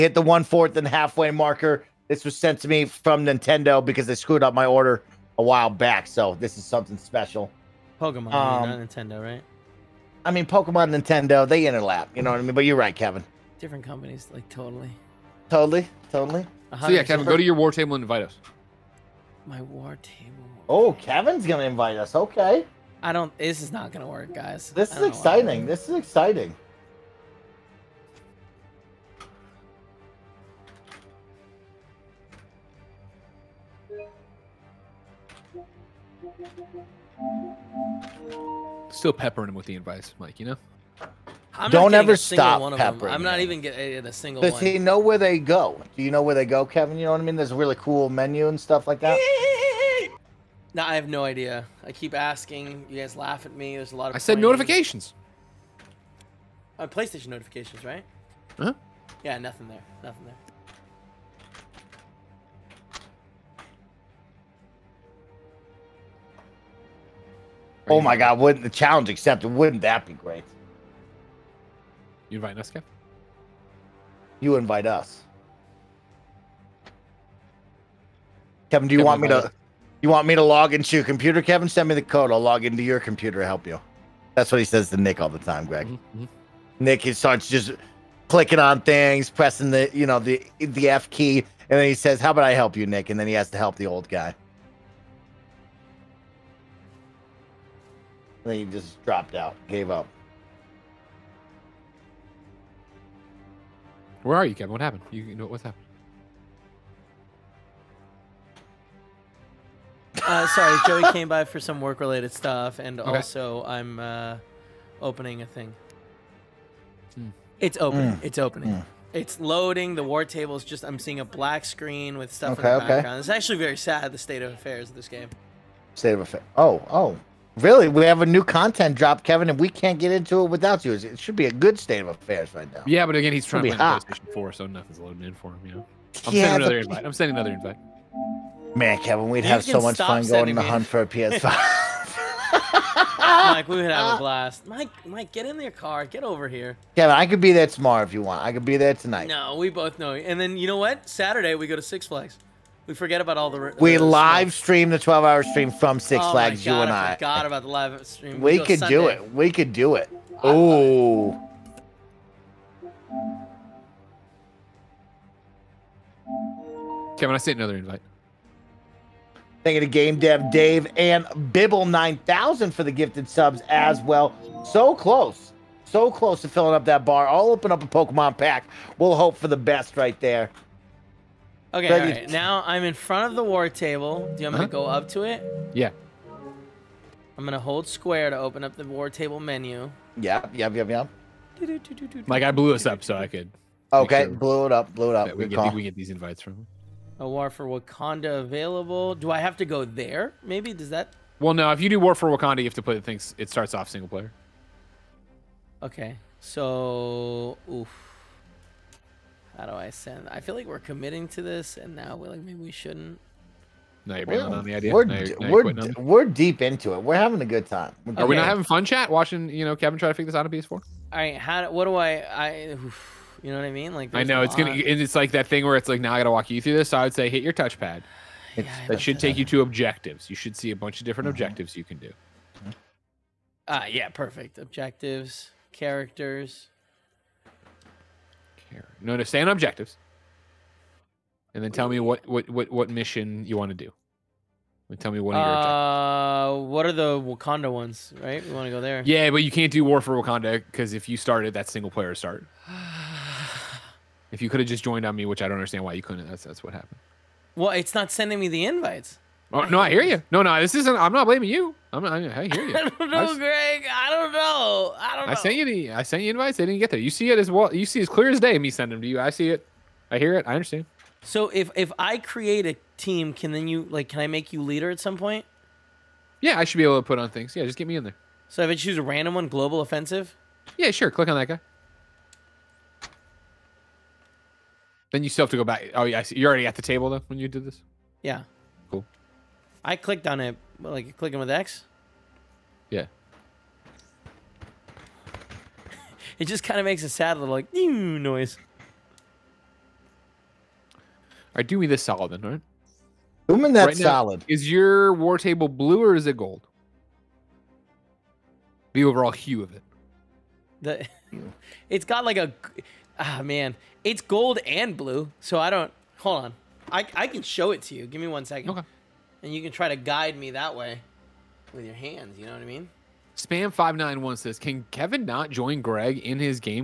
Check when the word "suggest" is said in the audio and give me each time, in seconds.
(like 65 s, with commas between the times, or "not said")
not said.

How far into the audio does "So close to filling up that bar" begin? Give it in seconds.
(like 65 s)
175 s.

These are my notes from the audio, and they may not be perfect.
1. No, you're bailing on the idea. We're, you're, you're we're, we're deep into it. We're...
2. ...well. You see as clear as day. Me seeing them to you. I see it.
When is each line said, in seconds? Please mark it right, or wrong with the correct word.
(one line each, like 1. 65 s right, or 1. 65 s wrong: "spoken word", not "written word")
1. 214 s right
2. 267 s wrong: "sending", not "seeing".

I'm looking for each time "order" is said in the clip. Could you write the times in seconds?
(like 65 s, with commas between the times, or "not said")
4 s.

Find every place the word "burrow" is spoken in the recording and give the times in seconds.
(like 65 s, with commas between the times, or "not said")
not said.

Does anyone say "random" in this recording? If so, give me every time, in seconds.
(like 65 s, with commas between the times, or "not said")
279 s.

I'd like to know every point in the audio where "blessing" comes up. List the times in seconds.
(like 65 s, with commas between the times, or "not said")
not said.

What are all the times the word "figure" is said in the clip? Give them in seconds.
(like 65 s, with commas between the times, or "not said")
220 s.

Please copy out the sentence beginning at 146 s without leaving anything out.
Kevin, I could be there tomorrow if you want.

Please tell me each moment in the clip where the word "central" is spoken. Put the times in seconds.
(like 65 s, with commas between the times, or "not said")
not said.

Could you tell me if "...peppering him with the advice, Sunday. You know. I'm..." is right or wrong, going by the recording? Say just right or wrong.
wrong.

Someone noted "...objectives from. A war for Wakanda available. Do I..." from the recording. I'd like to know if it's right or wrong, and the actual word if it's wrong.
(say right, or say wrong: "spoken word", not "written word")
wrong: "invites", not "objectives".